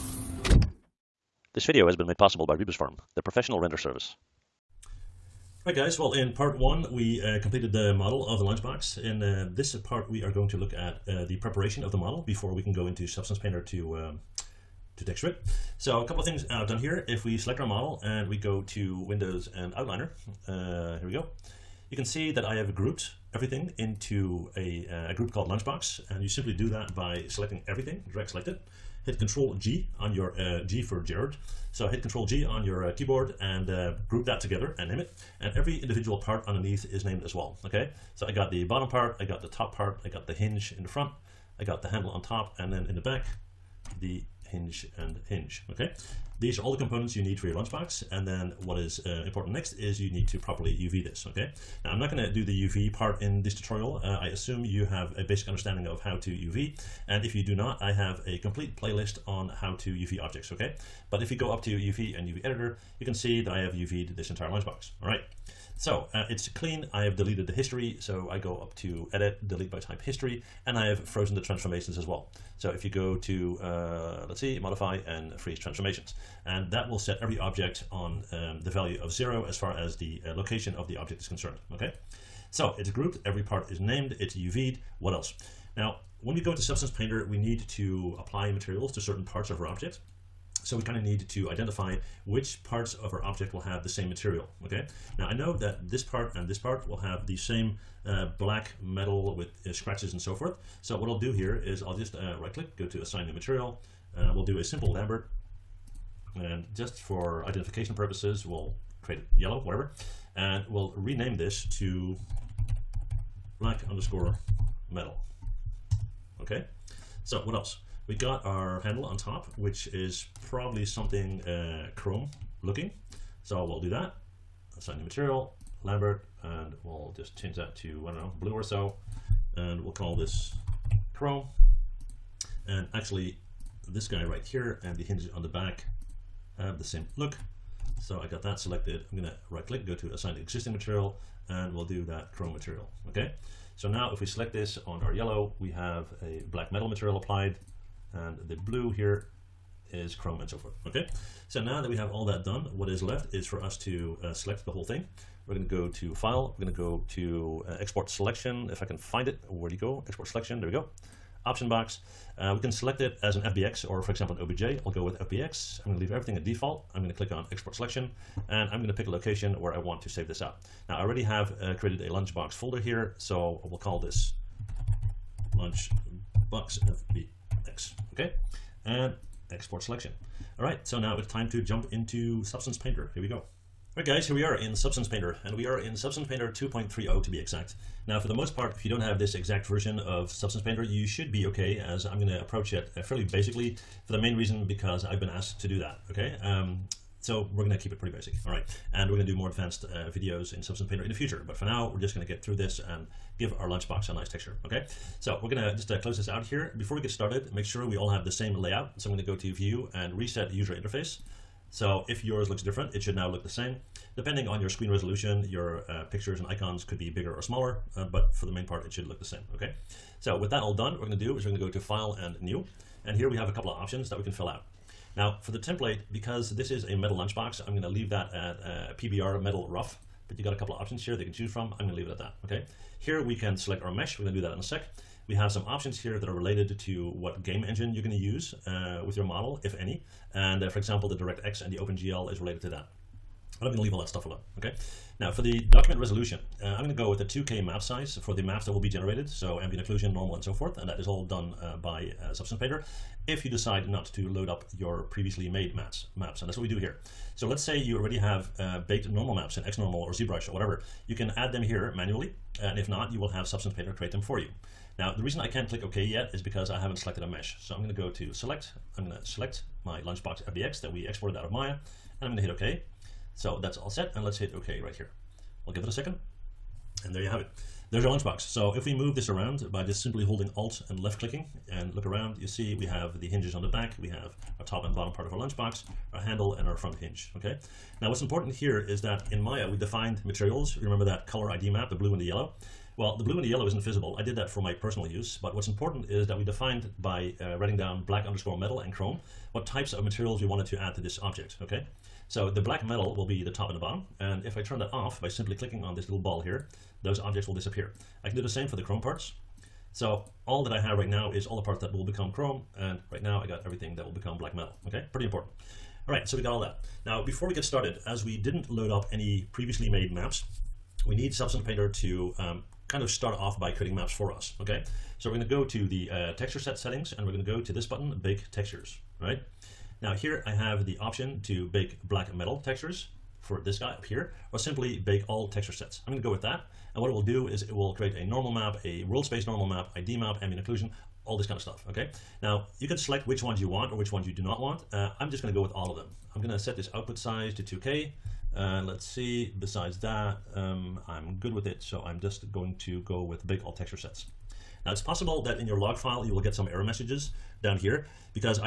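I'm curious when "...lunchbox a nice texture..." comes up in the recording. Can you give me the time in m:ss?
3:23.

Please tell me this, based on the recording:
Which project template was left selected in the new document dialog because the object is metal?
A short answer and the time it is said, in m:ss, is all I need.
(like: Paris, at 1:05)
PBR metal rough, at 3:48.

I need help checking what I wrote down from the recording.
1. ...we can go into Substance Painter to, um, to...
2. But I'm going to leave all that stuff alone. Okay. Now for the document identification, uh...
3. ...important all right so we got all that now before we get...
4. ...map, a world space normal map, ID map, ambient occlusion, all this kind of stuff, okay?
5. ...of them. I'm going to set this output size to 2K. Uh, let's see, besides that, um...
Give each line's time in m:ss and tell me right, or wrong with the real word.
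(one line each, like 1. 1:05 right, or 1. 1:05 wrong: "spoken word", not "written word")
1. 0:12 right
2. 4:03 wrong: "resolution", not "identification"
3. 5:15 right
4. 5:38 right
5. 5:45 right.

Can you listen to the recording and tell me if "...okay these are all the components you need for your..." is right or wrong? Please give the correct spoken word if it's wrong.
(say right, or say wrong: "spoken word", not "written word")
right.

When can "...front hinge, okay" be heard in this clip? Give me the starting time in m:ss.
4:46.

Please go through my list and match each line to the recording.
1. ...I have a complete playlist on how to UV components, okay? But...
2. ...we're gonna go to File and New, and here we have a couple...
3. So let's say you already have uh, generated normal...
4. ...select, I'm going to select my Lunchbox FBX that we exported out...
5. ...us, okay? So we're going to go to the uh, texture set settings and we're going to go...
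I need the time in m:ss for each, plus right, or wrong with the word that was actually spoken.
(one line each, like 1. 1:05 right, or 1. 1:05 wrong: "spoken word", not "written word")
1. 0:57 wrong: "objects", not "components"
2. 3:41 right
3. 4:17 wrong: "baked", not "generated"
4. 4:28 right
5. 5:24 right.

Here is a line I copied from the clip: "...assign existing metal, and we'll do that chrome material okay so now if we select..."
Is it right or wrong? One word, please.
wrong.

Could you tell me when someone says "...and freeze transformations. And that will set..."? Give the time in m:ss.
1:15.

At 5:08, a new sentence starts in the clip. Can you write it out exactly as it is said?
I can do the same for the chrome parts.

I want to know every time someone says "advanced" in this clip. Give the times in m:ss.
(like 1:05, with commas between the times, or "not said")
3:19.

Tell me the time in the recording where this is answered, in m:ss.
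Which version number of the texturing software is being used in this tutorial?
3:06.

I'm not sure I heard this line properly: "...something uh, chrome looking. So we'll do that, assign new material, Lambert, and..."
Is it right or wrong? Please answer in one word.
right.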